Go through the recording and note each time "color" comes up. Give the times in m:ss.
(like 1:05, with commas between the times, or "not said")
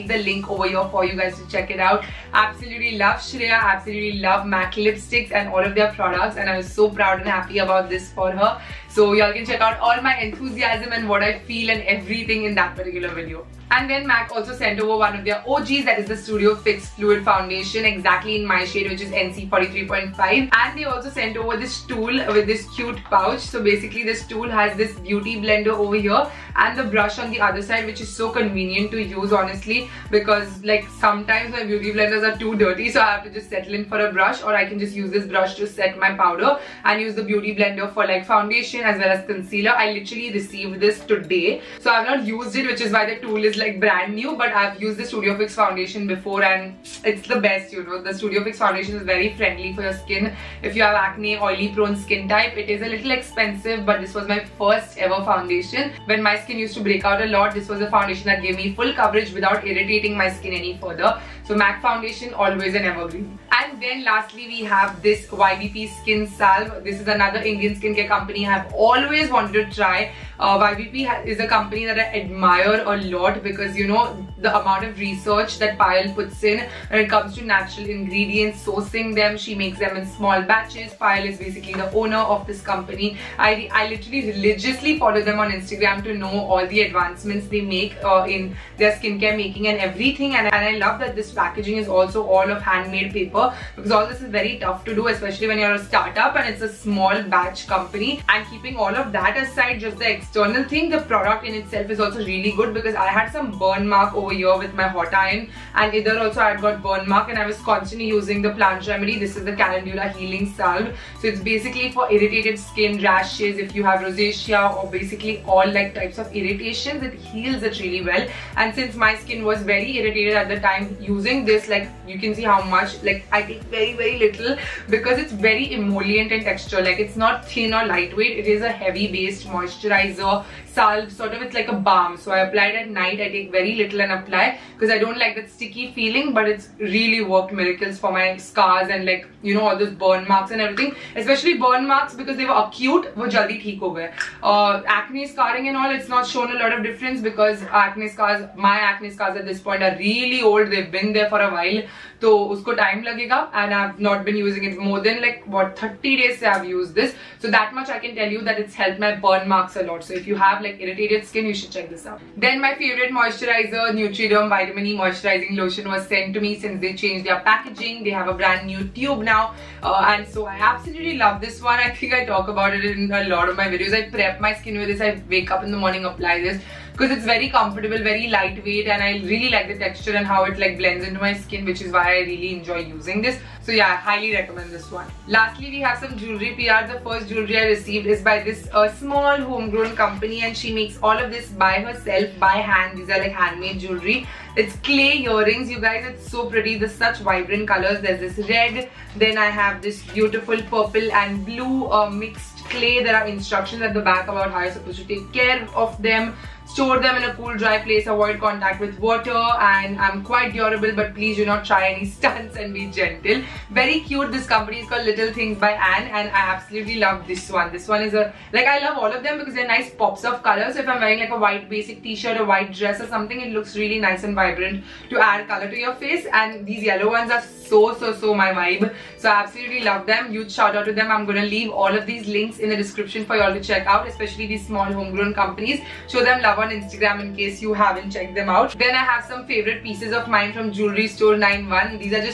3:17, 3:40, 3:45.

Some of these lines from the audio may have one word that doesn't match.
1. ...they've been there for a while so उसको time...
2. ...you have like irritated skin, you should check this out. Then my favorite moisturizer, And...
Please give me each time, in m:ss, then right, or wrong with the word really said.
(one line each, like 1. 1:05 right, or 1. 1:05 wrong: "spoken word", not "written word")
1. 2:30 right
2. 2:40 wrong: "Nutriderm", not "And".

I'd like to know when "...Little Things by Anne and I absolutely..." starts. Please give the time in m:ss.
3:35.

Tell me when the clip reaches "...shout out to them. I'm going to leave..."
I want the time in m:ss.
3:50.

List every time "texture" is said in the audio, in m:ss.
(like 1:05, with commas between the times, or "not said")
2:06, 2:59.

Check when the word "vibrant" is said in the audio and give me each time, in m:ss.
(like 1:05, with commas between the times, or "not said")
3:17, 3:44.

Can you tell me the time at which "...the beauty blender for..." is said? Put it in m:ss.
0:37.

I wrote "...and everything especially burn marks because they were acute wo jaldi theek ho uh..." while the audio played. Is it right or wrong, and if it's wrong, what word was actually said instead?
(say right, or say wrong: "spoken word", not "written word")
right.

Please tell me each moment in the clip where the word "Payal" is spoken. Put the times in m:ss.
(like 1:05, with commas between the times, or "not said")
1:15, 1:20.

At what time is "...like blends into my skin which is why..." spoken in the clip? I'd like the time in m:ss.
3:00.